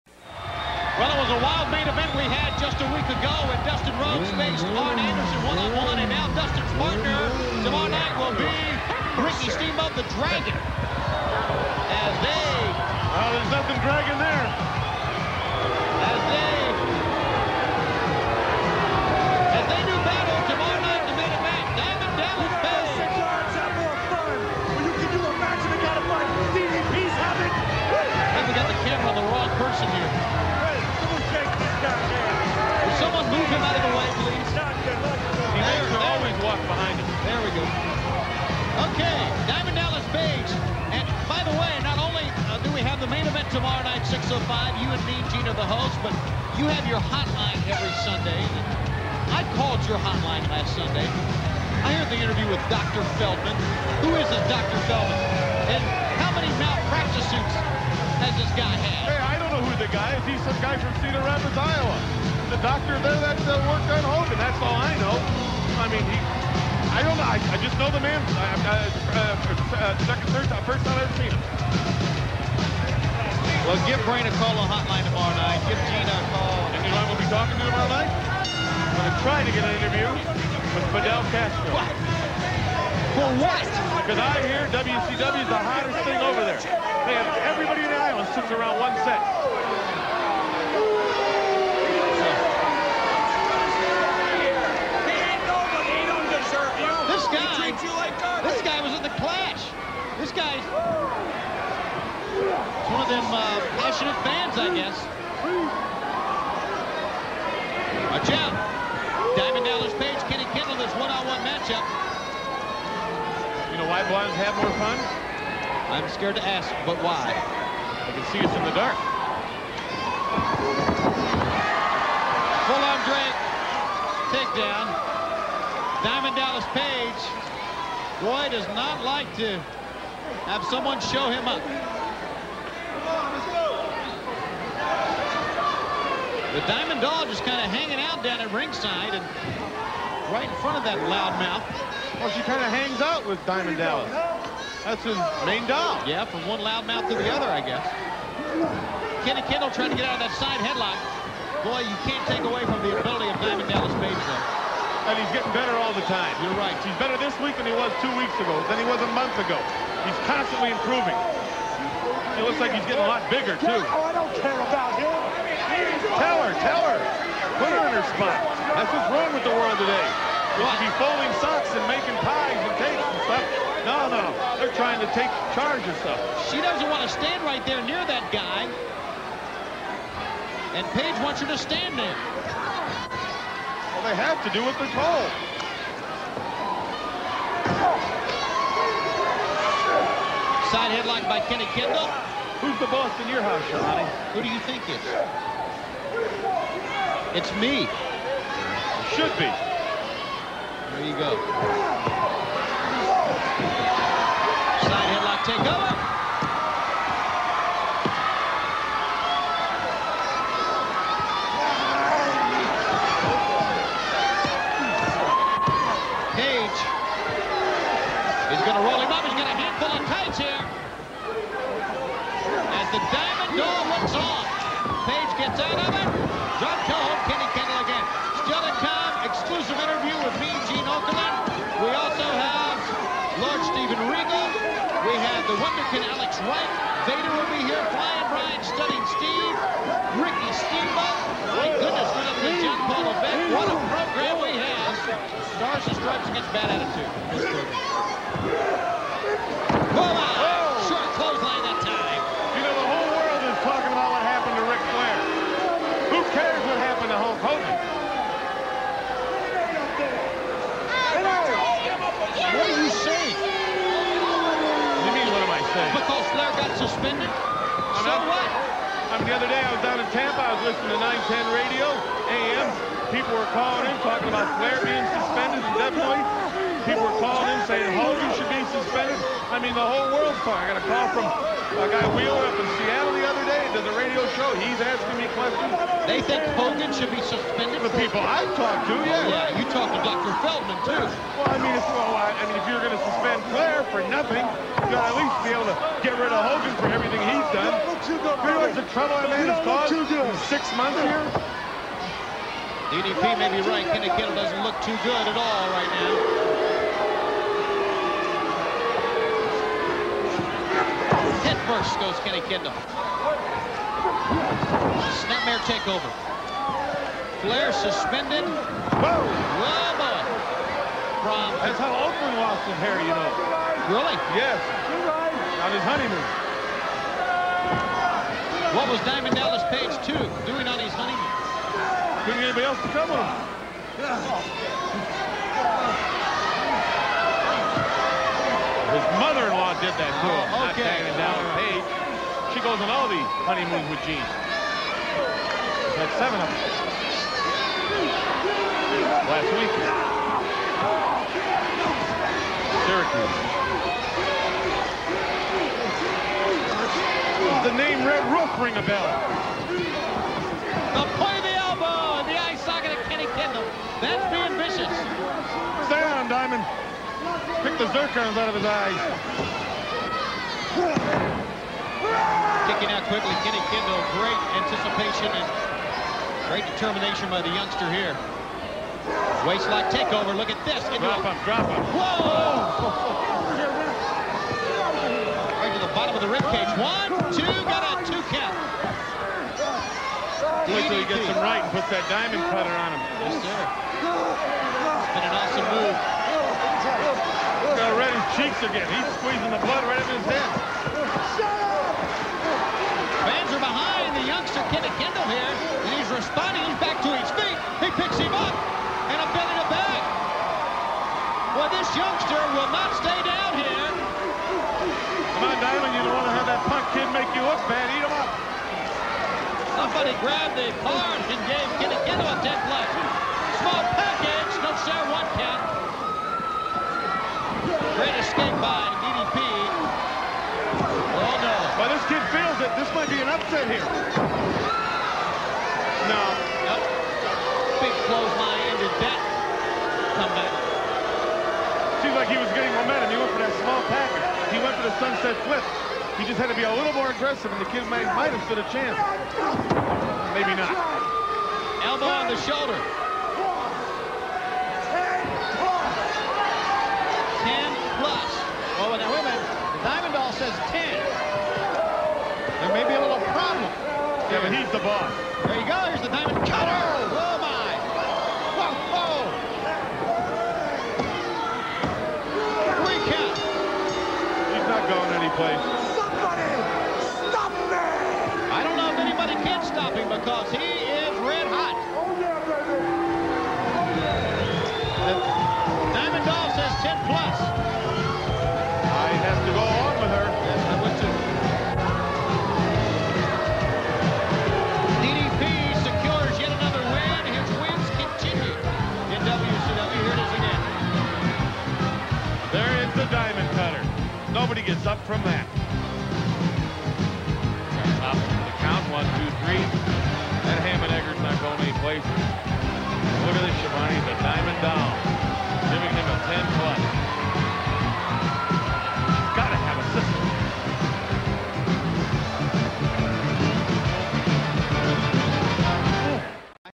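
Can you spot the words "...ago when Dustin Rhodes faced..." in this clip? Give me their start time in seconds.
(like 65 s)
3 s.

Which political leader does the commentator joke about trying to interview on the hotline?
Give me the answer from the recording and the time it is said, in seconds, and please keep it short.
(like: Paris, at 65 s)
Fidel Castro, at 80 s.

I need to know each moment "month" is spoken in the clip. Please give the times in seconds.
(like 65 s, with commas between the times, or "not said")
159 s, 300 s.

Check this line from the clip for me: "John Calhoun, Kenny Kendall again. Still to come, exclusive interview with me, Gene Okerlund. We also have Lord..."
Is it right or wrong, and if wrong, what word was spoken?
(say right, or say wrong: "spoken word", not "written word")
right.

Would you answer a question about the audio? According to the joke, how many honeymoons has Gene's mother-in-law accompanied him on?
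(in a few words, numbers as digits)
7.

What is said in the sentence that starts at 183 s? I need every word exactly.
Well, they have to do what they're told.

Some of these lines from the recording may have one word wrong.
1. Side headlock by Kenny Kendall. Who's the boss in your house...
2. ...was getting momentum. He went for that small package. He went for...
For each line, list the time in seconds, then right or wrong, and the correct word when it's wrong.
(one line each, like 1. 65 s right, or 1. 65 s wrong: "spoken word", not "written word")
1. 190 s right
2. 442 s right.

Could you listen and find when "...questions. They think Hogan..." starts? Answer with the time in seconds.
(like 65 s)
285 s.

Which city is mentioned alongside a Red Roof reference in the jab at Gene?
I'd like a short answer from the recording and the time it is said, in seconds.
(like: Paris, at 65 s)
Syracuse, at 353 s.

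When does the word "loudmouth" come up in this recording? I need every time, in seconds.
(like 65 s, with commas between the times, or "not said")
141 s, 146 s.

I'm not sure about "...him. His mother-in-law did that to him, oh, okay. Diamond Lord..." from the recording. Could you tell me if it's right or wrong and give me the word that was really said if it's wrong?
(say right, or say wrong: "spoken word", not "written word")
wrong: "Dallas", not "Lord".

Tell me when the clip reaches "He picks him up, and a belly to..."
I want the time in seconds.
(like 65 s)
407 s.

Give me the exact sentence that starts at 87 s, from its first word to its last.
They have everybody in the island sits around one set.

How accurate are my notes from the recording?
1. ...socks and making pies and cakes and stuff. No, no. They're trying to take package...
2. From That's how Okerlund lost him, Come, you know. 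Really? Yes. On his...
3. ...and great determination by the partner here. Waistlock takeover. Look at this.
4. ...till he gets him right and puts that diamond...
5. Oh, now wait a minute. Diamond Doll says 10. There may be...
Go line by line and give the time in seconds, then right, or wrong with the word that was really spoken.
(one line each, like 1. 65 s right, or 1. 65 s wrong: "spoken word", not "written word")
1. 171 s wrong: "charge", not "package"
2. 321 s wrong: "Harry", not "Come"
3. 375 s wrong: "youngster", not "partner"
4. 390 s right
5. 458 s right.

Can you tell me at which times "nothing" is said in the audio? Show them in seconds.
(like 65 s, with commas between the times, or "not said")
13 s, 294 s.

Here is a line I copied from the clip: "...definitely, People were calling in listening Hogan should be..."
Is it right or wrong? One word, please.
wrong.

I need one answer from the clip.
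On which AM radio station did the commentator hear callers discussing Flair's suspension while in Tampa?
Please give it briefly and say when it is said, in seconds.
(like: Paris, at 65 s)
910, at 271 s.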